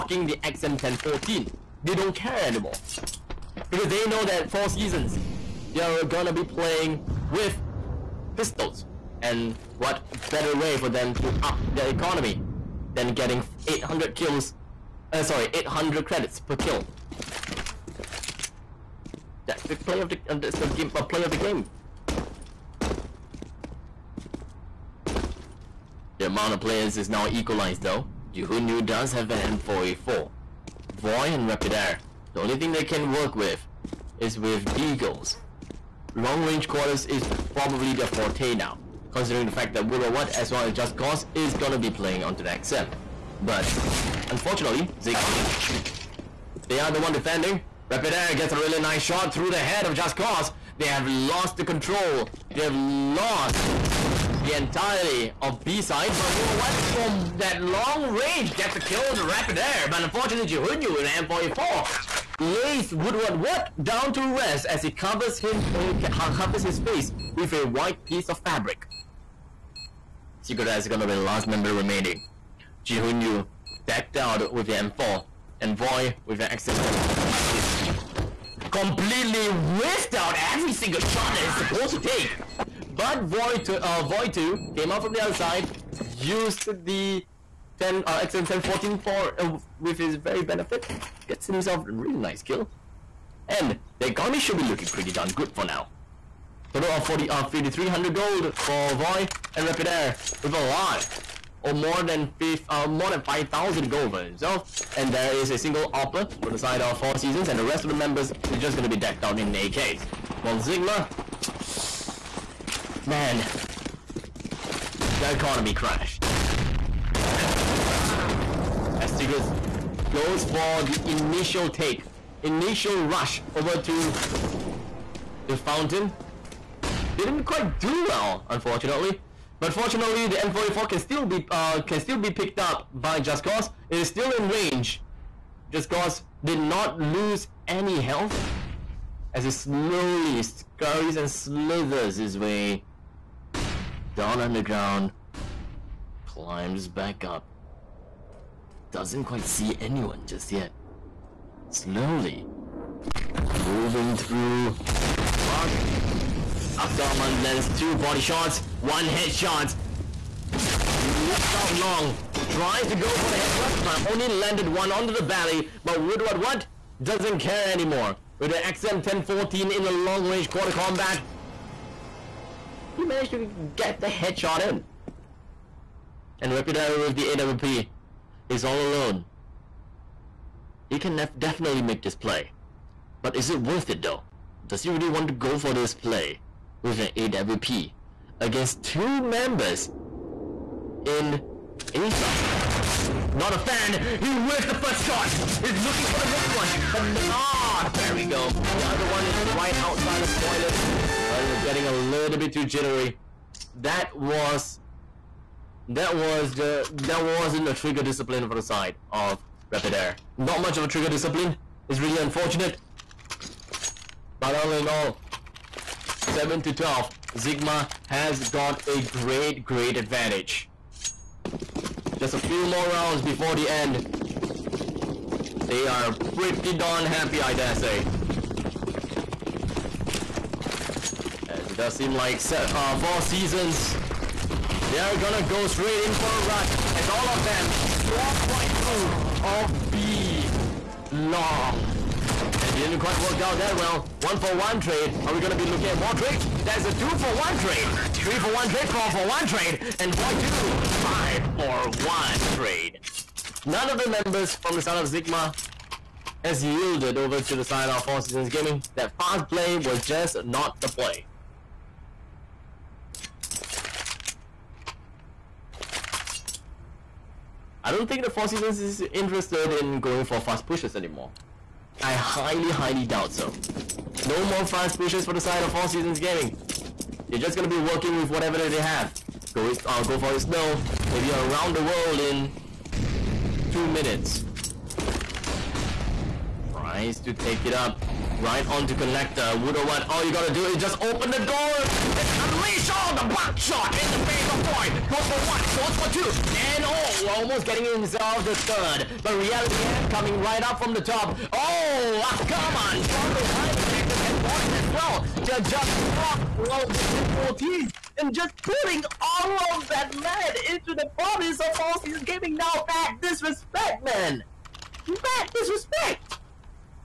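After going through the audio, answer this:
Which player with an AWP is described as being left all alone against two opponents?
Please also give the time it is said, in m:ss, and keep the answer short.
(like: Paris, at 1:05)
Reputero, at 2:56.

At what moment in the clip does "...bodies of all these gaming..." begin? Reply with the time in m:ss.
5:11.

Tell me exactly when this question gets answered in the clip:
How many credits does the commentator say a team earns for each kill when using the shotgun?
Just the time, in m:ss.
0:15.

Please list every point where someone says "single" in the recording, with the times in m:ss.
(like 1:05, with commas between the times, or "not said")
1:20, 1:45.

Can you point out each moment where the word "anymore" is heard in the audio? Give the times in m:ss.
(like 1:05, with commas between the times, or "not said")
0:02, 2:47, 4:30.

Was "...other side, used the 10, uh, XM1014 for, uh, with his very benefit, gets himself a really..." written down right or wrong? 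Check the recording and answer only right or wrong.
right.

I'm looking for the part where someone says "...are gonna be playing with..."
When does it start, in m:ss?
0:05.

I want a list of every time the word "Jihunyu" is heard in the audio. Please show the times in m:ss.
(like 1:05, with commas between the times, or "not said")
0:28, 1:00, 1:12.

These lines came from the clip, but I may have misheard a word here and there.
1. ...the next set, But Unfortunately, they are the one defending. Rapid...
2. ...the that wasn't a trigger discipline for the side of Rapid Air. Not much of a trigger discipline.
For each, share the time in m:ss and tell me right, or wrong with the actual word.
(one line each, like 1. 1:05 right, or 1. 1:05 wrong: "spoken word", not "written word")
1. 0:42 right
2. 3:26 right.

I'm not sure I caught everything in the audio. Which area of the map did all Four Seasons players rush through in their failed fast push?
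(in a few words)
B long.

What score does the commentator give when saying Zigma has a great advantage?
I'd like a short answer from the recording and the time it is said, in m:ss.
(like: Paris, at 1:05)
7 to 12, at 3:36.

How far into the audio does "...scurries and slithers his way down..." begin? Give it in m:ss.
2:20.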